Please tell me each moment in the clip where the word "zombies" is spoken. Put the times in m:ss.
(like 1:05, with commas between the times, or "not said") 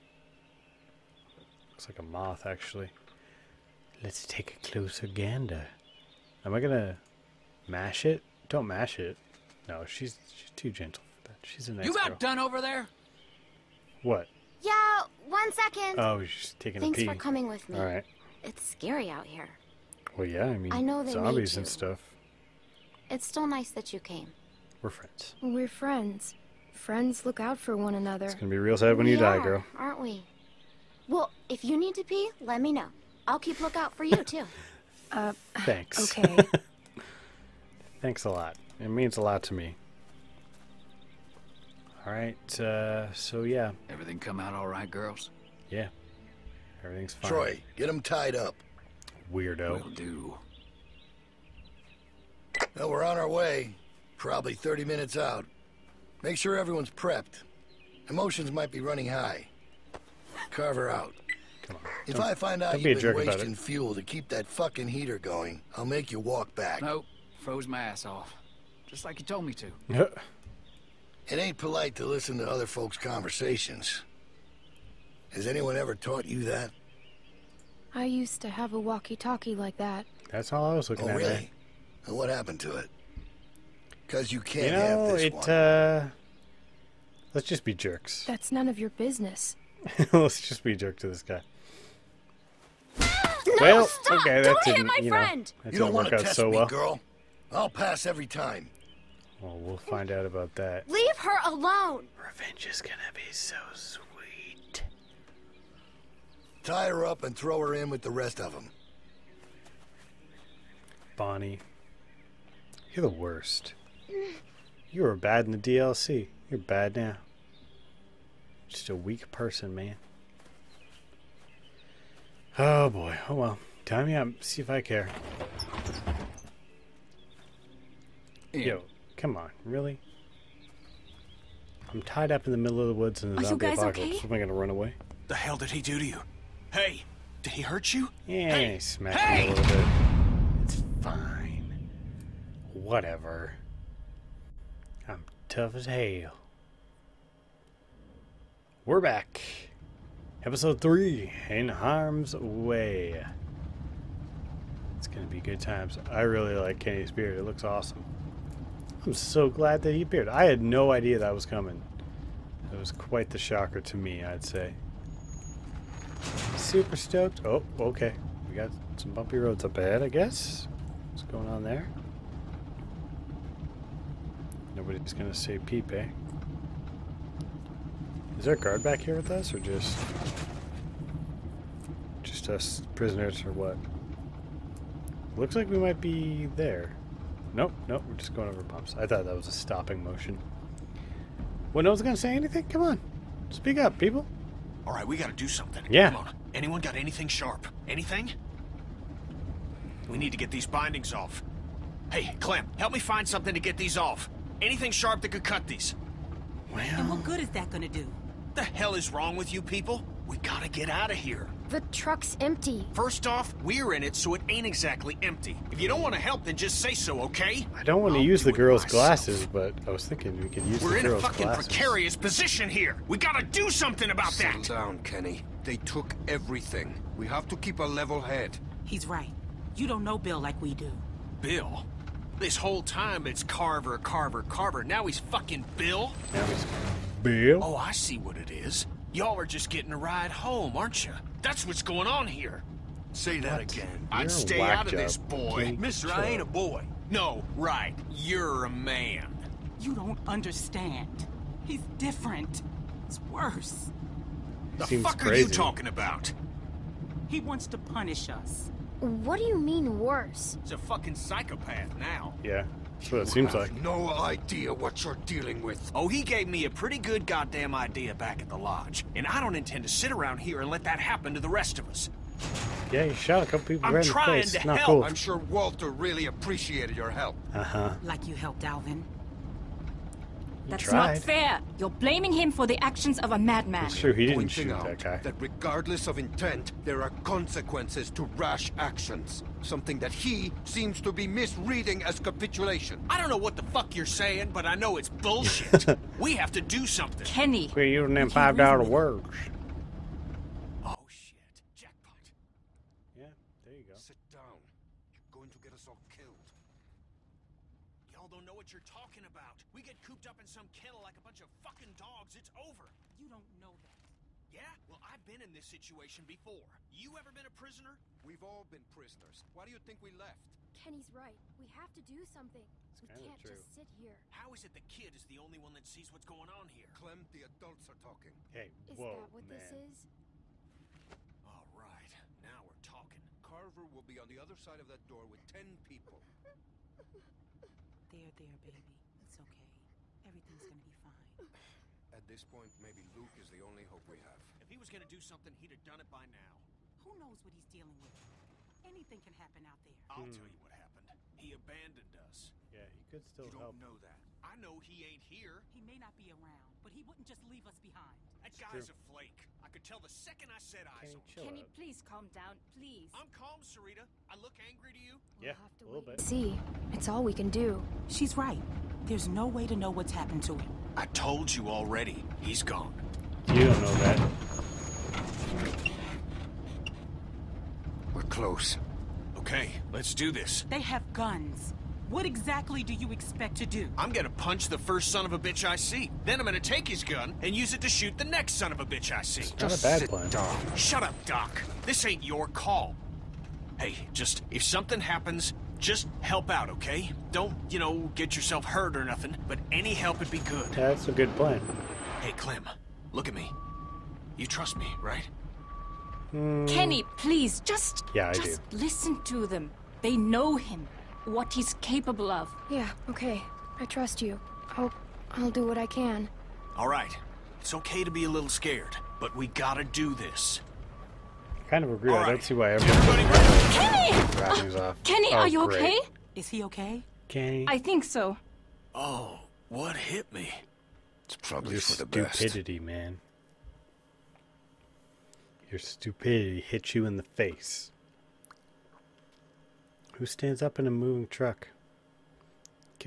0:21, 2:13.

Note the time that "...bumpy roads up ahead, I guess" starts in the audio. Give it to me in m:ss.
2:49.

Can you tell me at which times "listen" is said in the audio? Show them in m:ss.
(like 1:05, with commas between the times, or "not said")
1:12, 6:48.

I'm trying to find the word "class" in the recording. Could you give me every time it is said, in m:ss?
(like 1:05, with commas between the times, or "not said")
not said.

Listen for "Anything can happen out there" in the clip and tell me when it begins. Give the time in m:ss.
5:48.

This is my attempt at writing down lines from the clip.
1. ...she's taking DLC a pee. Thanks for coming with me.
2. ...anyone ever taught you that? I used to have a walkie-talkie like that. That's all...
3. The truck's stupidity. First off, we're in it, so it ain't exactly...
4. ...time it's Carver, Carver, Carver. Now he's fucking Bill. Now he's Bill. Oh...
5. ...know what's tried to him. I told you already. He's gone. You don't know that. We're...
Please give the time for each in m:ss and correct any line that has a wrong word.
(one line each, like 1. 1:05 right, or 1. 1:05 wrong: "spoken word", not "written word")
1. 0:16 wrong: "Thanks", not "DLC"
2. 1:15 right
3. 3:31 wrong: "empty", not "stupidity"
4. 3:52 right
5. 6:09 wrong: "happened", not "tried".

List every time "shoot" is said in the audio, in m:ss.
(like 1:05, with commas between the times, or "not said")
4:44, 6:27.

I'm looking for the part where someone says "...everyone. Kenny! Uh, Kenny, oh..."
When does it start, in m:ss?
7:02.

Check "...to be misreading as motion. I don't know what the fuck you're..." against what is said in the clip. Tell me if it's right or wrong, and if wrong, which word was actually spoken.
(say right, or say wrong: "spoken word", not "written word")
wrong: "capitulation", not "motion".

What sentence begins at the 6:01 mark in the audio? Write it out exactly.
Can you please calm down, please?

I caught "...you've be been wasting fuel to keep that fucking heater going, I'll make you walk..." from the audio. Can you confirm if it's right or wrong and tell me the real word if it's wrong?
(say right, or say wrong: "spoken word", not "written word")
right.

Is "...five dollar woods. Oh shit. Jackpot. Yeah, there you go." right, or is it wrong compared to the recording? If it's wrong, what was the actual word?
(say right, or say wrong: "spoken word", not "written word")
wrong: "words", not "woods".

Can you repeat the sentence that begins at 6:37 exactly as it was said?
Don't, you know, get yourself hurt or nothing, but any help would be good.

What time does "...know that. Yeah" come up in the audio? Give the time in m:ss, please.
5:13.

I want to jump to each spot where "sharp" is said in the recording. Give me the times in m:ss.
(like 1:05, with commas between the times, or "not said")
3:17, 3:24.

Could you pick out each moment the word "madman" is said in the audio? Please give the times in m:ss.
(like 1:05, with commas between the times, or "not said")
4:43.